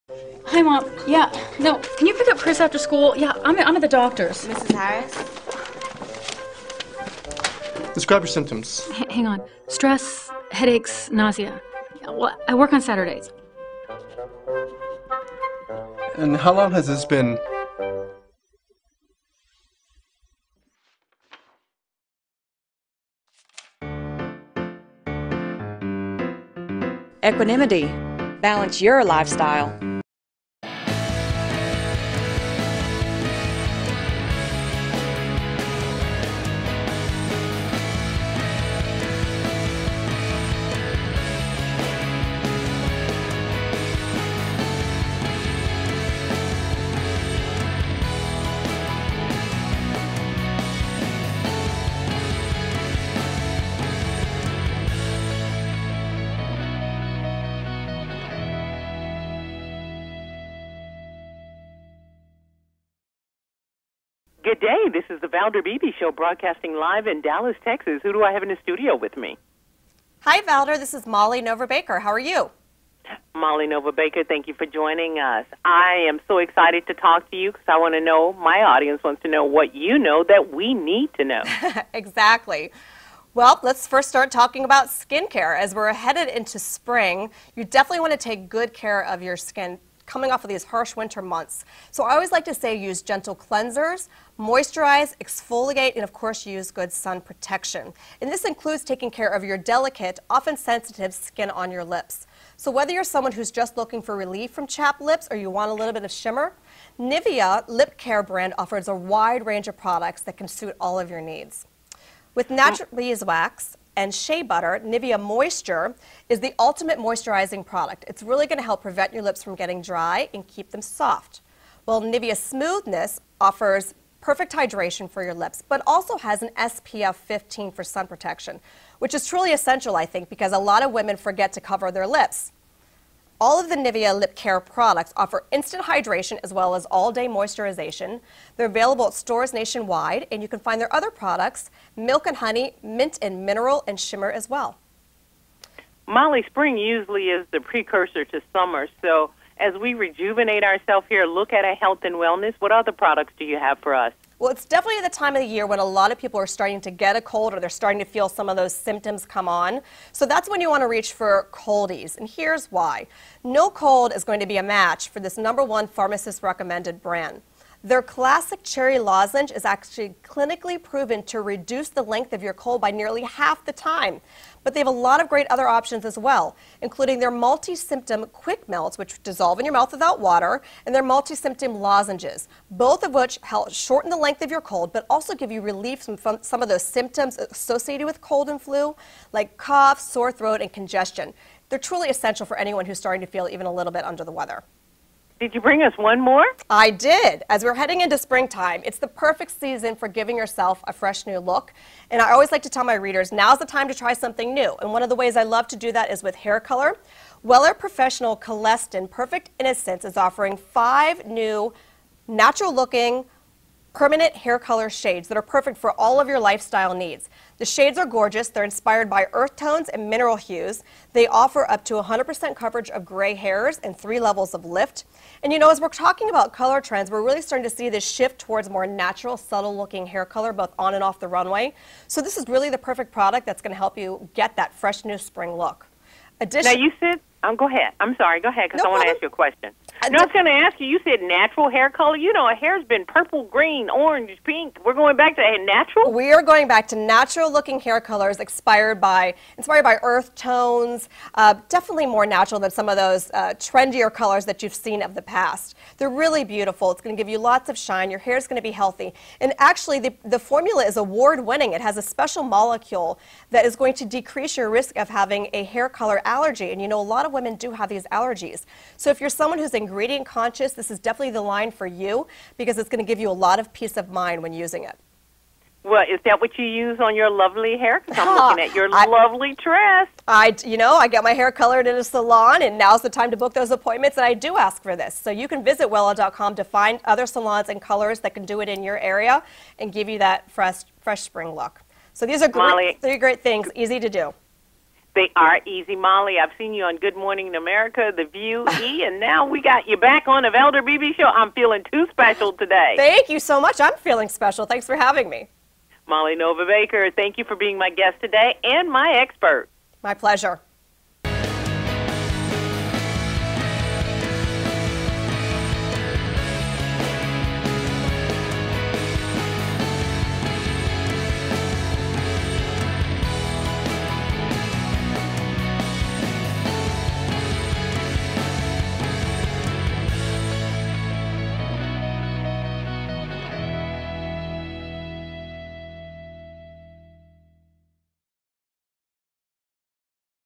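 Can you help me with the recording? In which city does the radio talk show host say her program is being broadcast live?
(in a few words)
Dallas, Texas.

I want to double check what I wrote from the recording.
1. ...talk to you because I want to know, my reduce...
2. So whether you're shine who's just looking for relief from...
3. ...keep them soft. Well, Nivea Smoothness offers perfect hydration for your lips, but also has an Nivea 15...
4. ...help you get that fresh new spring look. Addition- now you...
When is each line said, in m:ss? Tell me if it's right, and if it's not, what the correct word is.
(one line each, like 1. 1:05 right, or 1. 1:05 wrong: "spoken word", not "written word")
1. 1:16 wrong: "audience", not "reduce"
2. 1:42 wrong: "someone", not "shine"
3. 2:00 wrong: "SPF", not "Nivea"
4. 3:53 right.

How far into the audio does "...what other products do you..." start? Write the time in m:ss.
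2:32.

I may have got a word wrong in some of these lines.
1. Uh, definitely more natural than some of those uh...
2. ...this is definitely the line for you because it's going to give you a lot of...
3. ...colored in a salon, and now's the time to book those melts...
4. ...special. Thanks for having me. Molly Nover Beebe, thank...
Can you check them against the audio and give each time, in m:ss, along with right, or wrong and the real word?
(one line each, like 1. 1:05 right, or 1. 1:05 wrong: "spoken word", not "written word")
1. 4:11 right
2. 4:30 right
3. 4:41 wrong: "appointments", not "melts"
4. 5:04 wrong: "Baker", not "Beebe".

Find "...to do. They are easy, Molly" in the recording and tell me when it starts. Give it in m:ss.
4:53.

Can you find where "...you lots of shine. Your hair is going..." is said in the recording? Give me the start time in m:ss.
4:17.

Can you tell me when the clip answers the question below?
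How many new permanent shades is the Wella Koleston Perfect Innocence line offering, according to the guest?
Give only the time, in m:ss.
3:30.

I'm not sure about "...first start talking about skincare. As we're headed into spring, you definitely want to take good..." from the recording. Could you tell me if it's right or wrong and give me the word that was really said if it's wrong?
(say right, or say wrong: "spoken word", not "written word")
right.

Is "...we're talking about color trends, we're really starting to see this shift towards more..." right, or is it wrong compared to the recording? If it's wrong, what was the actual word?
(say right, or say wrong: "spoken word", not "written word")
right.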